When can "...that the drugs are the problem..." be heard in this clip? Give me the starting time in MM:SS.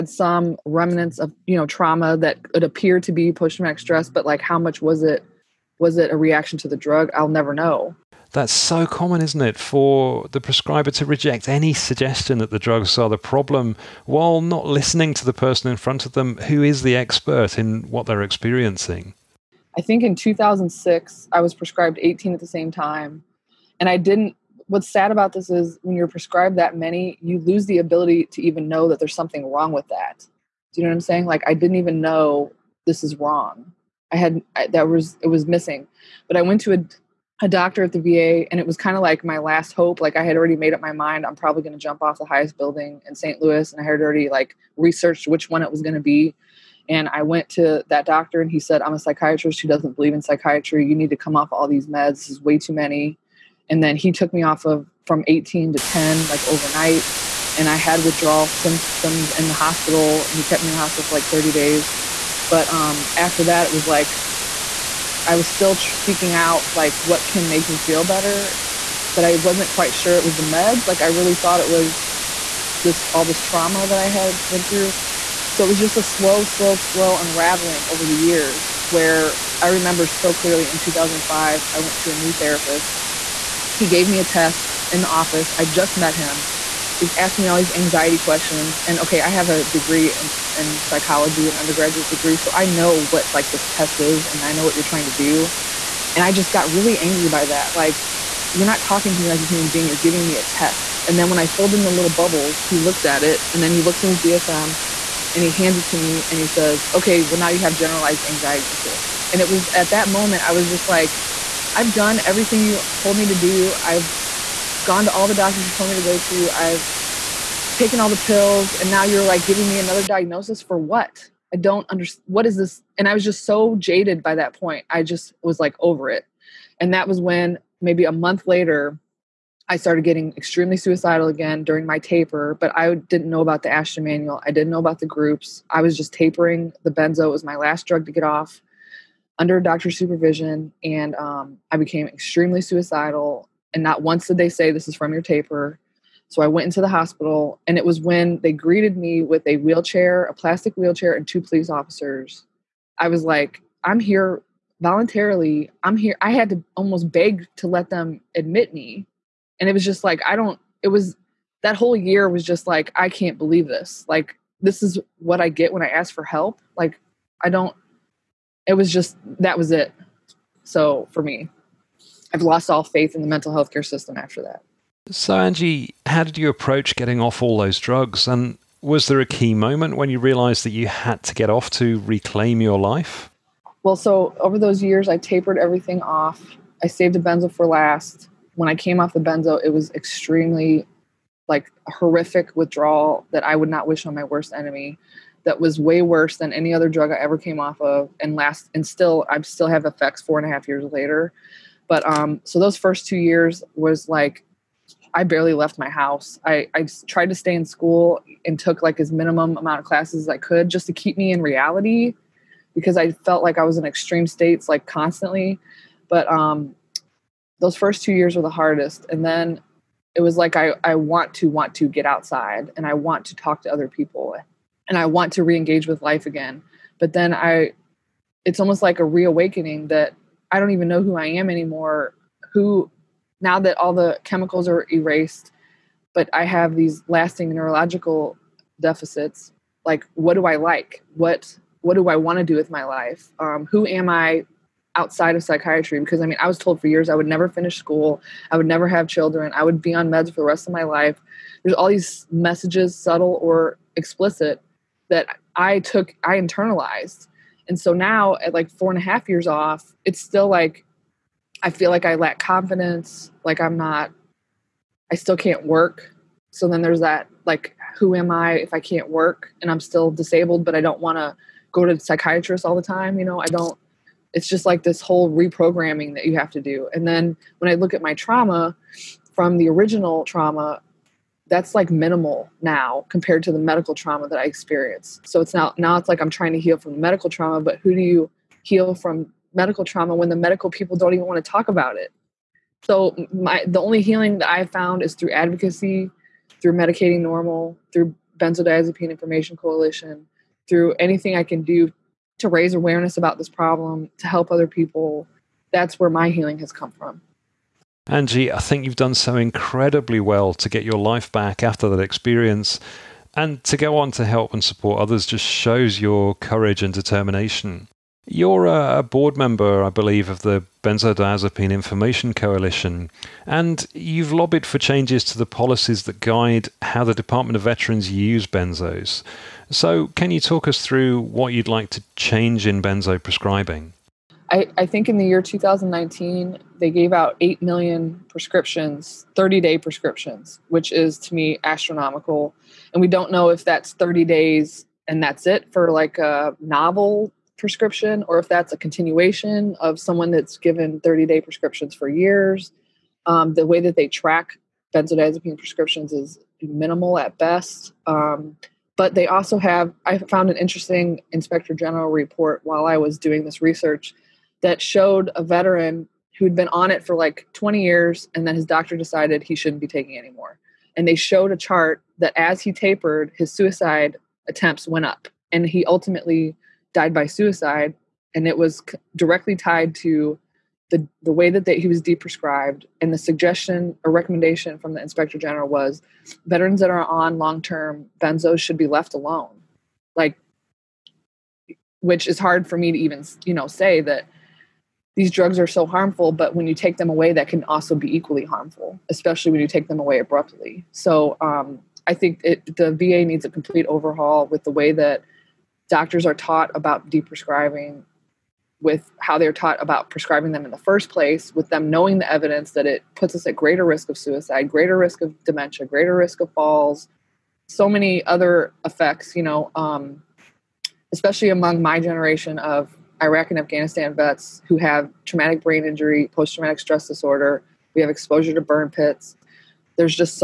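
00:12.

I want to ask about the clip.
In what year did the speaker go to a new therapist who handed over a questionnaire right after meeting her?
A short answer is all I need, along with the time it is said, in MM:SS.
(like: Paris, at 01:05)
2005, at 01:20.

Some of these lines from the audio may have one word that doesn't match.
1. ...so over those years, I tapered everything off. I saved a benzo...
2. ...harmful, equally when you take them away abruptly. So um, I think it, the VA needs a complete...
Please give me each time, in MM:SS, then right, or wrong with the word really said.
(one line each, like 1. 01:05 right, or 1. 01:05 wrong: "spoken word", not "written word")
1. 03:03 right
2. 06:38 wrong: "especially", not "equally".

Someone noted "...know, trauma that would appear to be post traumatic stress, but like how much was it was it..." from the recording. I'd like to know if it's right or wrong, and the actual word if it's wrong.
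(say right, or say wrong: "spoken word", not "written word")
right.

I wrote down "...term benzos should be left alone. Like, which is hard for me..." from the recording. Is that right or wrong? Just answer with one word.
right.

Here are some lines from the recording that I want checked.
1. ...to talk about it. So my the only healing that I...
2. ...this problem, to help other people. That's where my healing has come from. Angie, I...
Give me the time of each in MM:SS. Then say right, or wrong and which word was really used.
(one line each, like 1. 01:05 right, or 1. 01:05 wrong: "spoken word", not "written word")
1. 04:51 right
2. 05:03 right.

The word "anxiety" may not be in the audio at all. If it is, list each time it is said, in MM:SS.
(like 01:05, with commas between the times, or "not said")
01:27, 01:48.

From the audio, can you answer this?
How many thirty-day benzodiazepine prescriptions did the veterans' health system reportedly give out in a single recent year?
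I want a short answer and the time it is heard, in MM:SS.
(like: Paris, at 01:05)
8 million, at 05:37.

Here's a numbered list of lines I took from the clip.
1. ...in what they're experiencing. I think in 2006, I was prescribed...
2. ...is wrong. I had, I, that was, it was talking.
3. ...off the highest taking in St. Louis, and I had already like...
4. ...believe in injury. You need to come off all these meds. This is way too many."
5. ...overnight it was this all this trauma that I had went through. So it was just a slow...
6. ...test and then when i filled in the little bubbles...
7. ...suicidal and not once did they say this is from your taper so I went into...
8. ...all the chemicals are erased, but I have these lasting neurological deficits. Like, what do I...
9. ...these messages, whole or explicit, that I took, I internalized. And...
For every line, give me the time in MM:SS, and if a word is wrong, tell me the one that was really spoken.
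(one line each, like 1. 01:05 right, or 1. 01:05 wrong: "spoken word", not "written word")
1. 00:17 right
2. 00:33 wrong: "missing", not "talking"
3. 00:42 wrong: "building", not "taking"
4. 00:49 wrong: "psychiatry", not "injury"
5. 01:11 wrong: "thought", not "overnight"
6. 01:40 right
7. 02:22 right
8. 03:53 right
9. 04:11 wrong: "subtle", not "whole".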